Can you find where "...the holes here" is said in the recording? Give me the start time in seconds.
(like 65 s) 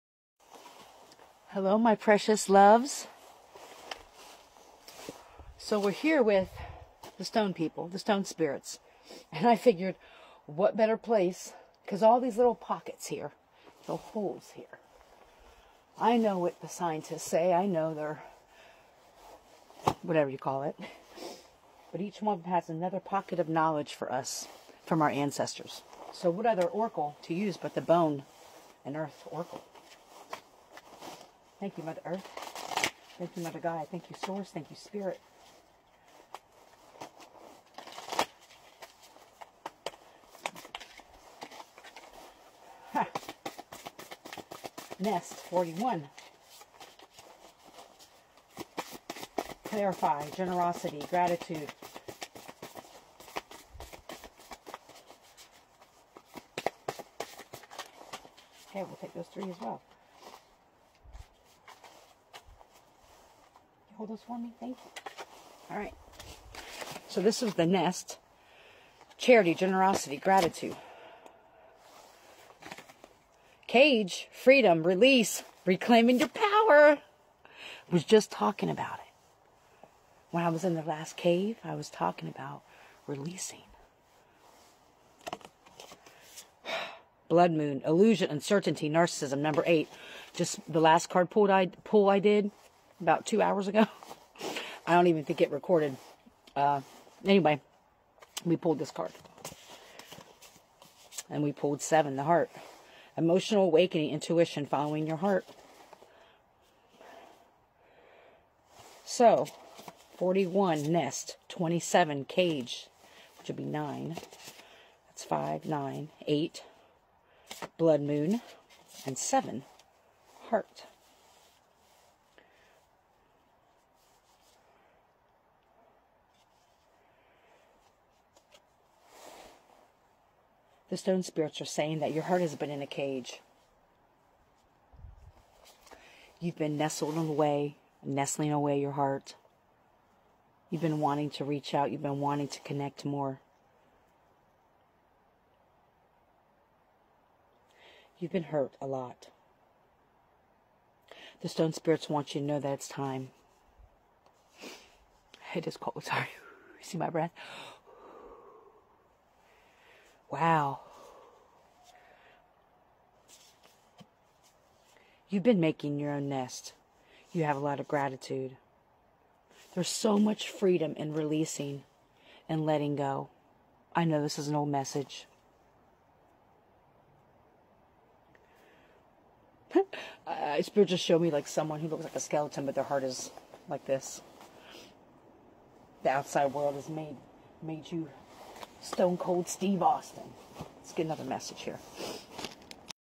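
13 s.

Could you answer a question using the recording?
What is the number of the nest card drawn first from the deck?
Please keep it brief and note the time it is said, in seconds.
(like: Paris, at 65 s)
41, at 44 s.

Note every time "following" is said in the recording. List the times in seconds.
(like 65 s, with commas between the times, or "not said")
104 s.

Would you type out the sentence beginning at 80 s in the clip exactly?
When I was in the last cave, I was talking about releasing.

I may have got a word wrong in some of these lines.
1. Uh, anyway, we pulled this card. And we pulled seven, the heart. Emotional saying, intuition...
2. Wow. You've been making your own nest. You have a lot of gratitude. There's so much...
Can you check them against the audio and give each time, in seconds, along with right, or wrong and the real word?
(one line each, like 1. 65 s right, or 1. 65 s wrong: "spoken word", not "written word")
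1. 96 s wrong: "awakening", not "saying"
2. 160 s right.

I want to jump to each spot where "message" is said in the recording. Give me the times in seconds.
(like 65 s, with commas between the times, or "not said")
174 s, 191 s.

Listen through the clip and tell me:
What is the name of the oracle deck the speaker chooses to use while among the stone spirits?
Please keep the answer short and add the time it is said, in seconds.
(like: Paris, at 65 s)
bone and earth oracle, at 27 s.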